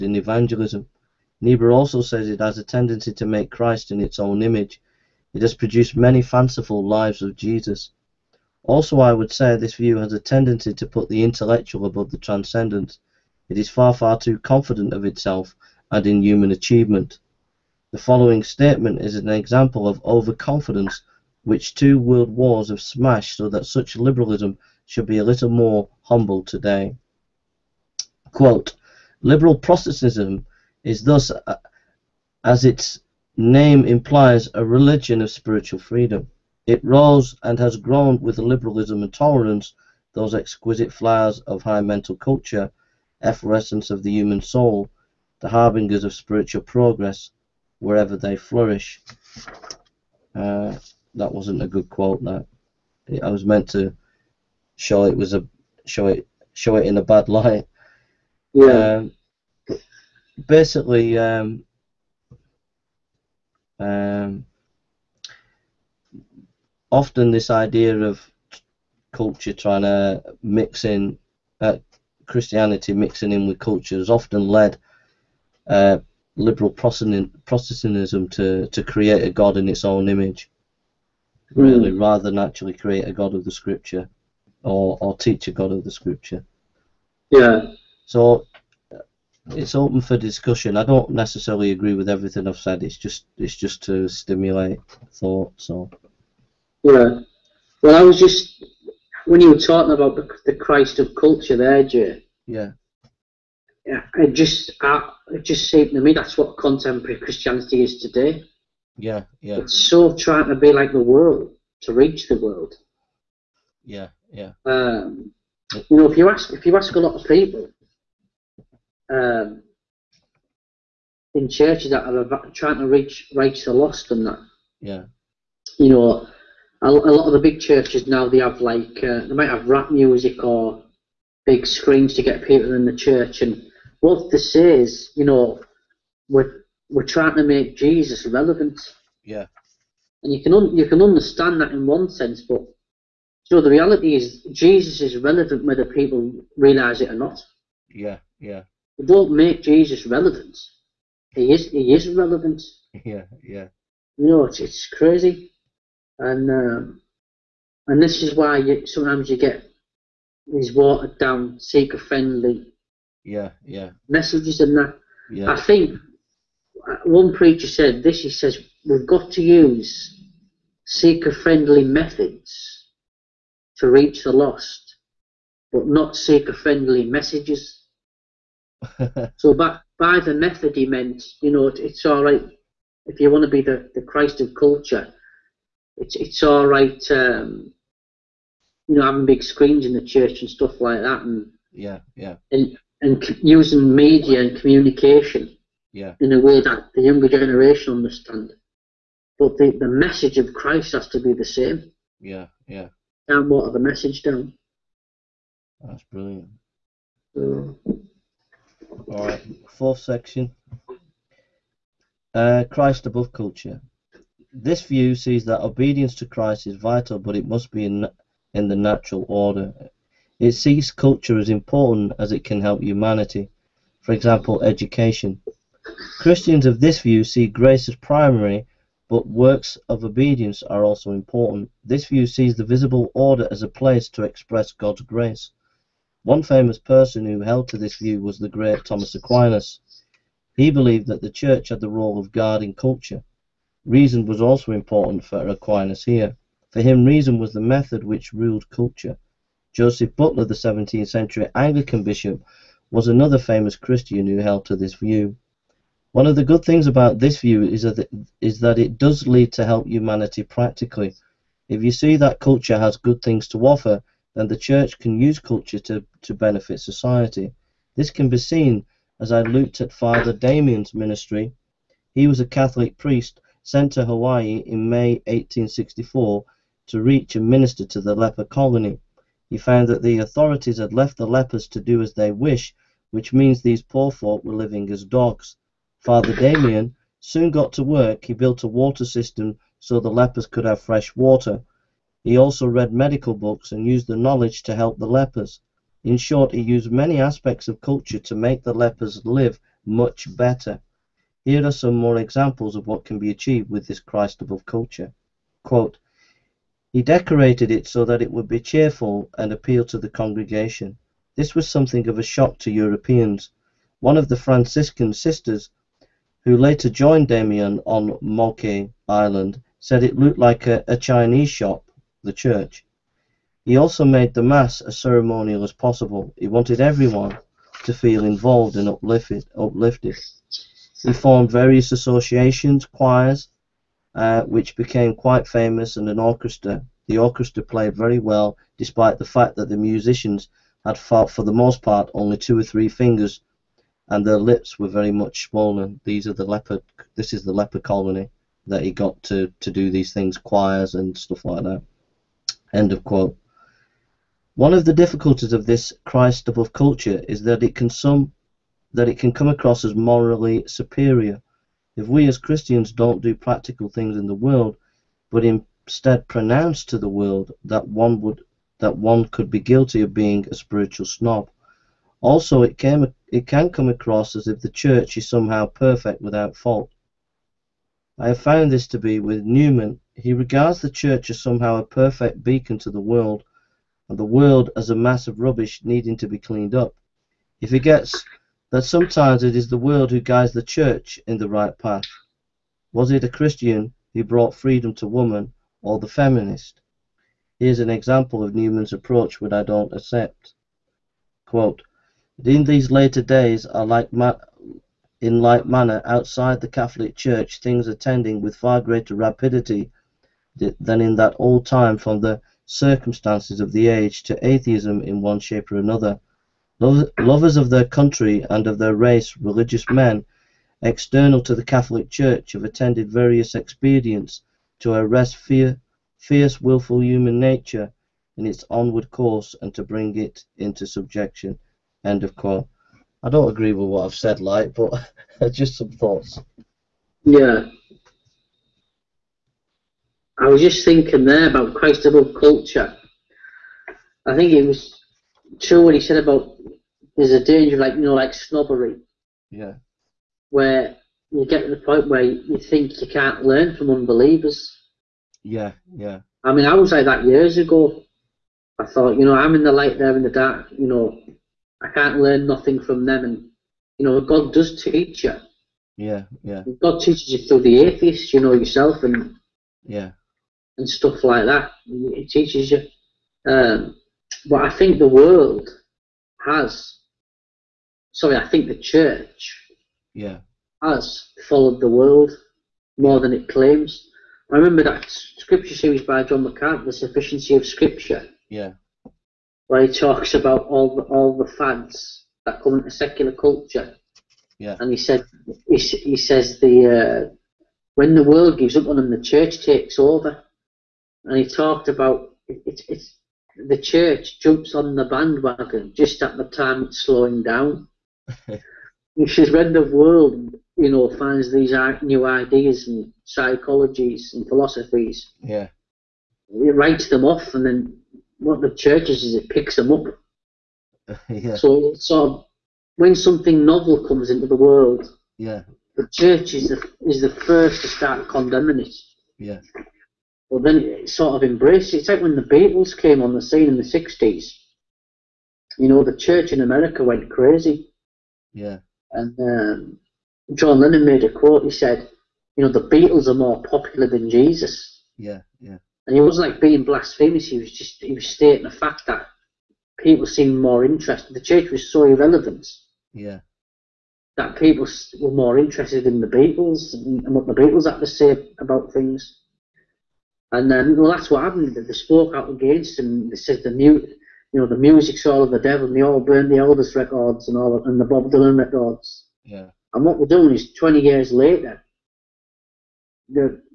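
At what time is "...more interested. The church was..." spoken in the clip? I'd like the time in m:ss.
9:10.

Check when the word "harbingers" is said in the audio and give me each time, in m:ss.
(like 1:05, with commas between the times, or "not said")
0:45.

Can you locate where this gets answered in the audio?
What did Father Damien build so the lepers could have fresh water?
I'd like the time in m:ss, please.
4:48.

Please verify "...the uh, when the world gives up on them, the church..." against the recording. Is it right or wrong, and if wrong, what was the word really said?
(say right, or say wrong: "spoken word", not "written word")
right.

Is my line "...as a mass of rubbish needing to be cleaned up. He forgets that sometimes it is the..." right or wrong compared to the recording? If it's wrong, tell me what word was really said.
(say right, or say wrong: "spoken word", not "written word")
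right.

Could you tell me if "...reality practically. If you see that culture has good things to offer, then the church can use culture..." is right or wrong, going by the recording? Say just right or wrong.
wrong.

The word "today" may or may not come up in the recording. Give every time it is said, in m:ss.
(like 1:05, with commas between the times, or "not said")
0:26, 1:48.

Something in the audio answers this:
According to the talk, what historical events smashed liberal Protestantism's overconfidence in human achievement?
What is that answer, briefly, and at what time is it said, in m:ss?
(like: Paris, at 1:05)
two world wars, at 0:21.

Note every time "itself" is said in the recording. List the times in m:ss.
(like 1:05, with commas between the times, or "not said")
0:15.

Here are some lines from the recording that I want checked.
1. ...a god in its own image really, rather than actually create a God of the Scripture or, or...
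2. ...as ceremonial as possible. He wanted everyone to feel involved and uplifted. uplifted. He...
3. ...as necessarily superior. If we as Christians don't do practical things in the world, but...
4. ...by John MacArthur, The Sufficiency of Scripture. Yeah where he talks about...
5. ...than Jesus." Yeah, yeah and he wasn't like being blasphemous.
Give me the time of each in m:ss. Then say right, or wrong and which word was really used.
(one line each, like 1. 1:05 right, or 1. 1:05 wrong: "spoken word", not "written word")
1. 1:19 right
2. 5:24 right
3. 5:59 wrong: "morally", not "necessarily"
4. 8:06 right
5. 9:04 right.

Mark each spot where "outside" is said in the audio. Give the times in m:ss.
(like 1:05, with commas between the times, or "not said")
6:46.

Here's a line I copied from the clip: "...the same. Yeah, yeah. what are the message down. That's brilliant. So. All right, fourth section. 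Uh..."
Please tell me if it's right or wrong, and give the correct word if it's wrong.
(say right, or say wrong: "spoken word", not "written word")
right.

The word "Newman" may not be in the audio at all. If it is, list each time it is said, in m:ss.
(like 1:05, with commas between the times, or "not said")
6:19, 6:38.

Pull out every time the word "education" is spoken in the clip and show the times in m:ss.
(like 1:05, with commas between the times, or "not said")
3:44.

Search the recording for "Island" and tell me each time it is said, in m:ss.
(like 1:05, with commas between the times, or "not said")
5:19.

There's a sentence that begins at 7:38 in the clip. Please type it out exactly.
I thought, you know, I'm in the light, they're in the dark.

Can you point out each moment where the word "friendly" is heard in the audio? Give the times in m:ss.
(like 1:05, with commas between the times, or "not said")
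2:41, 2:50, 2:56.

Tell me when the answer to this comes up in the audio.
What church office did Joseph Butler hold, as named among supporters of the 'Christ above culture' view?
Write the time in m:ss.
4:11.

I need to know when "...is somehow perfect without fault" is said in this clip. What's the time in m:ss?
6:15.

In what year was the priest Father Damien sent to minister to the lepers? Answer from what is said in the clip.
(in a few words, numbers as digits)
1864.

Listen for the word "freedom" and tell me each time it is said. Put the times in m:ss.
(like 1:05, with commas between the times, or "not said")
0:35, 6:34.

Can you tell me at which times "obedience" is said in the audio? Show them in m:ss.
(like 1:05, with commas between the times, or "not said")
3:35, 3:50.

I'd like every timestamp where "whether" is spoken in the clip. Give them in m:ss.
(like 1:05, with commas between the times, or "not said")
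2:25.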